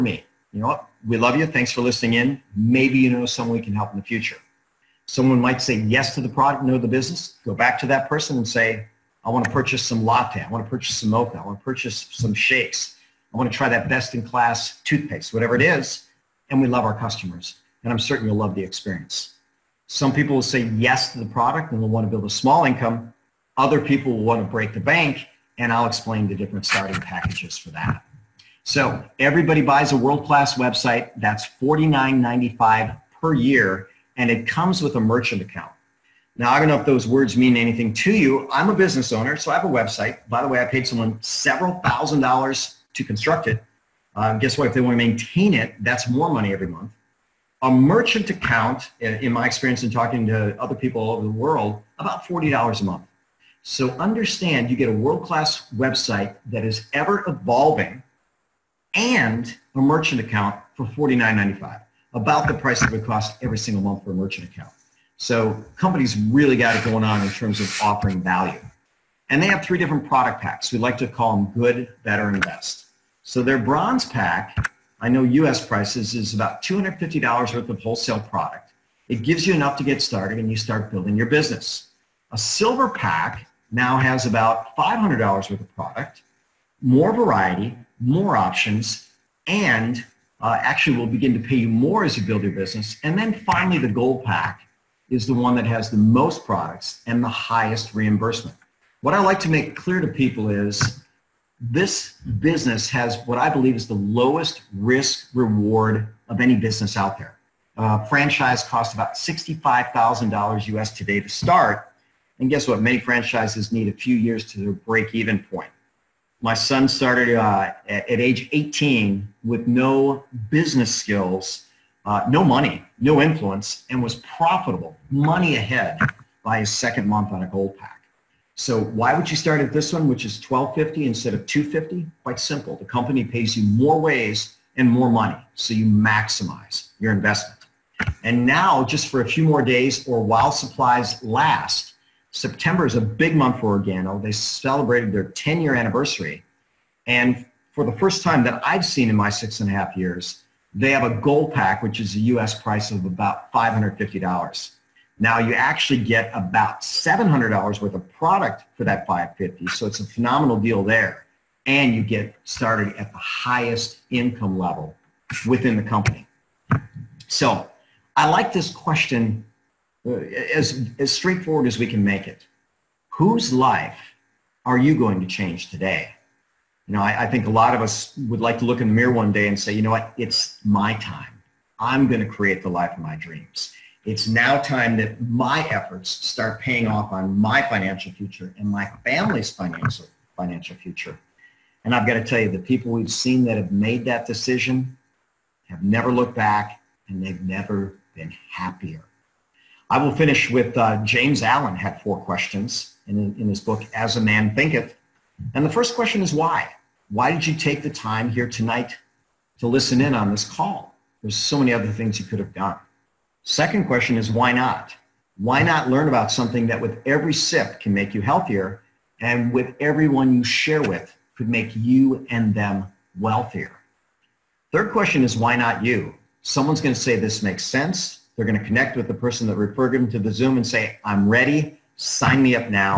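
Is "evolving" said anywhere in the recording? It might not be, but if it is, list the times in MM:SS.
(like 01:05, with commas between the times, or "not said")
00:57.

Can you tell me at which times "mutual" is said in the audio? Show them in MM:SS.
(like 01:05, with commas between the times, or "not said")
not said.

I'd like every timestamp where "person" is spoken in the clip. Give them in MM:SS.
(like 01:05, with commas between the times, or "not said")
00:08, 03:49.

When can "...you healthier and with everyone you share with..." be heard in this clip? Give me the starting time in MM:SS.
03:38.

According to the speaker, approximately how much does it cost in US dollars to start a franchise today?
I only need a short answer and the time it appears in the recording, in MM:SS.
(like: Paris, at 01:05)
$65,000, at 01:49.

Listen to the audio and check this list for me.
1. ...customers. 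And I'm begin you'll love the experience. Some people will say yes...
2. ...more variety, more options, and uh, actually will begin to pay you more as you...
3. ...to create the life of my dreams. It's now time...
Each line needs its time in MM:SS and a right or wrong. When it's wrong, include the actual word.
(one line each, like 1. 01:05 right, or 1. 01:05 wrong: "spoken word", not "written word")
1. 00:16 wrong: "certain", not "begin"
2. 01:26 right
3. 03:02 right.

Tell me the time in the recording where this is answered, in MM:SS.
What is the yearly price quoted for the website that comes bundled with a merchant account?
00:31.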